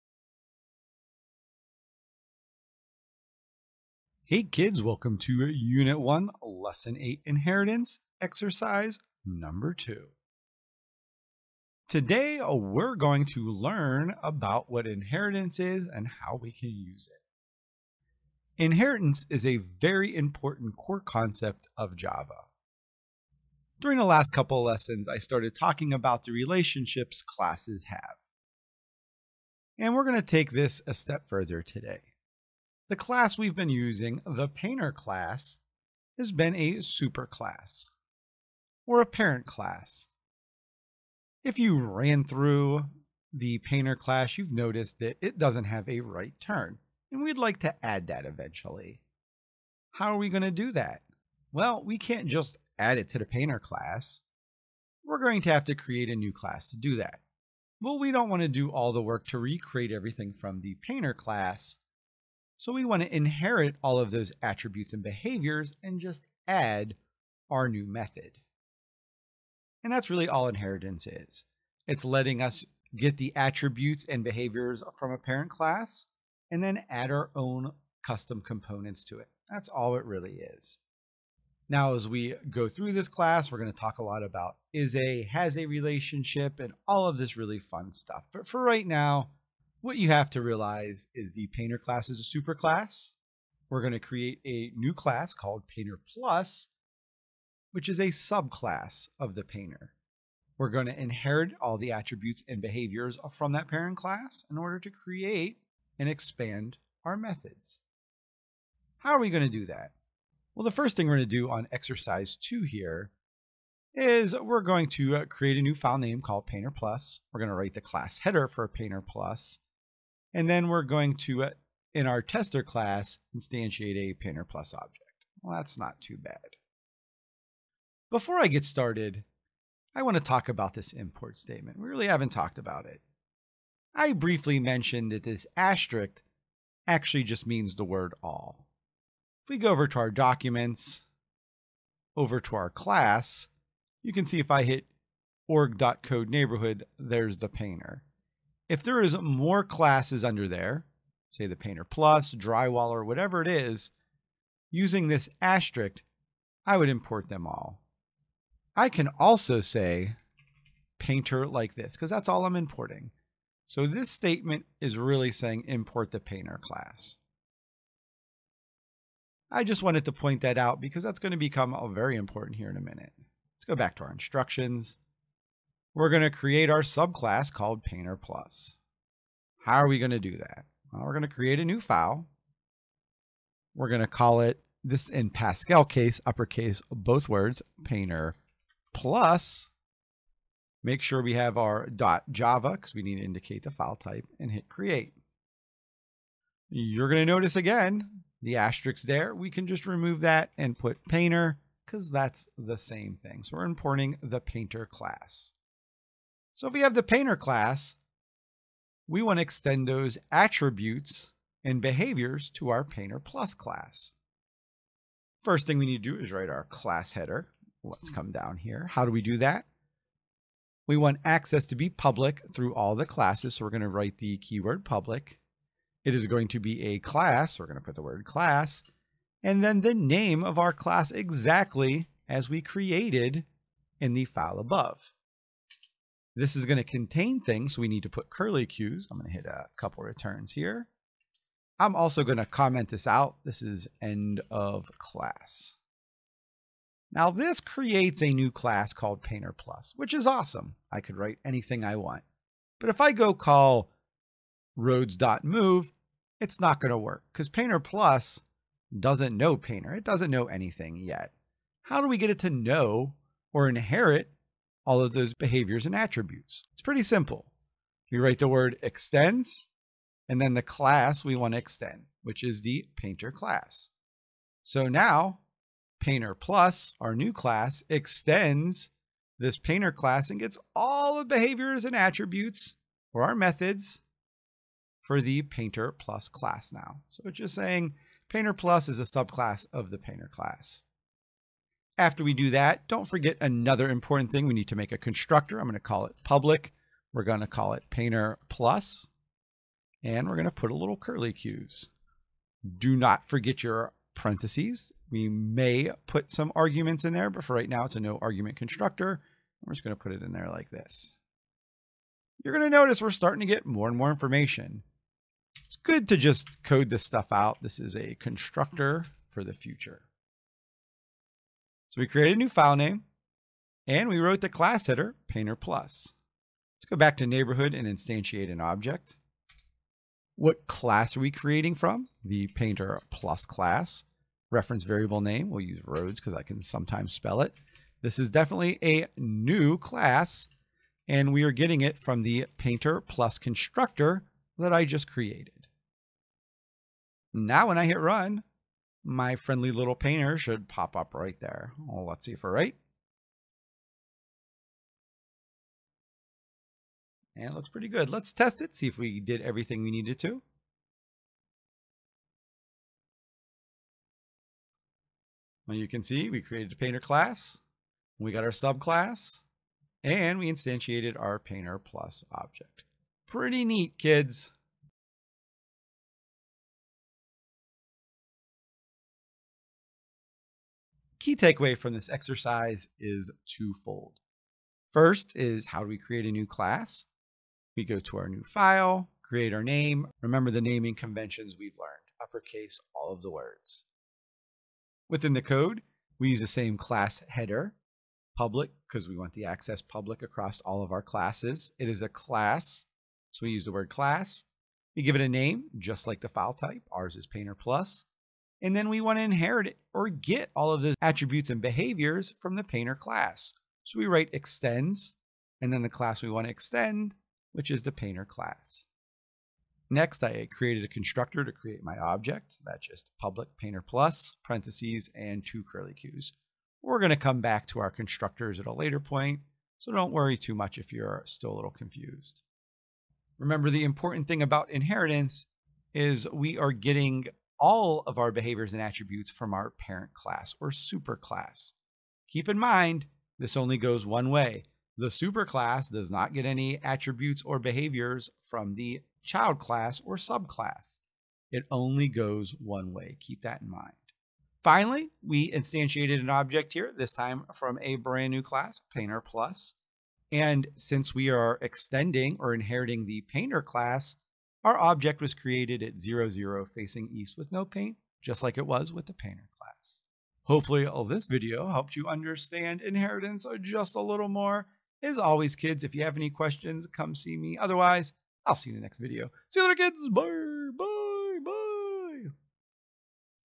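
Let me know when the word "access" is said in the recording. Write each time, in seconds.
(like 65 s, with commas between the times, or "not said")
221 s, 399 s.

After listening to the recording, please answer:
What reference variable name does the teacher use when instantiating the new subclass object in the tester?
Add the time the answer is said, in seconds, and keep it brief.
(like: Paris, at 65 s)
rhodes, at 335 s.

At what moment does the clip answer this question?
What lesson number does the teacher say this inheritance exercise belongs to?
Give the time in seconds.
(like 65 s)
6 s.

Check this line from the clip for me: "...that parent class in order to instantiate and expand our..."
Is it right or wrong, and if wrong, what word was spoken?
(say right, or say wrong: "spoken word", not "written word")
wrong: "create", not "instantiate".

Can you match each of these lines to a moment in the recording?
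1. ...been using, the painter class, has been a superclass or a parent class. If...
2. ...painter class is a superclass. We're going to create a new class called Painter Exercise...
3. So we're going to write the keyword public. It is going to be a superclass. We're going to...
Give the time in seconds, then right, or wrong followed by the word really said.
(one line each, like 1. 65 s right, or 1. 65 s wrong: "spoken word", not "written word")
1. 33 s right
2. 91 s wrong: "Plus", not "Exercise"
3. 223 s wrong: "class", not "superclass".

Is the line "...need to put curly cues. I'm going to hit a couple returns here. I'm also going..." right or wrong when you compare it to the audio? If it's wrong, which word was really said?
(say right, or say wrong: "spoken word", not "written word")
right.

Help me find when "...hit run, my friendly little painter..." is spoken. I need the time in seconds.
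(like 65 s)
347 s.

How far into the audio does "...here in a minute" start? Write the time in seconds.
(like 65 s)
172 s.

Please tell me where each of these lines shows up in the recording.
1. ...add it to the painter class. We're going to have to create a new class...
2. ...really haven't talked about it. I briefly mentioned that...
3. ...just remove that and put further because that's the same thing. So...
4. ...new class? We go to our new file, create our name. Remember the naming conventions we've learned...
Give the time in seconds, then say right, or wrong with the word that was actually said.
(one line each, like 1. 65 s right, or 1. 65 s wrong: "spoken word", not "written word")
1. 52 s right
2. 131 s right
3. 199 s wrong: "painter", not "further"
4. 386 s right.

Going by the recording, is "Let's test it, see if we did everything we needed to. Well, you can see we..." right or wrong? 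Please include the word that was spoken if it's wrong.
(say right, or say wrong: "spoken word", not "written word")
right.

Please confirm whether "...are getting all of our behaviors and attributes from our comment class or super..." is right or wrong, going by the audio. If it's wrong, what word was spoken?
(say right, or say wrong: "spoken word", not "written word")
wrong: "parent", not "comment".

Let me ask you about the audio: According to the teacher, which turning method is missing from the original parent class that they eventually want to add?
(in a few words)
right turn.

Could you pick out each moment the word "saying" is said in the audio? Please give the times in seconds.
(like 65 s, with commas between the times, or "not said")
165 s, 287 s.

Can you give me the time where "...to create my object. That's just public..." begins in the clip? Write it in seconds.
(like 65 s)
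421 s.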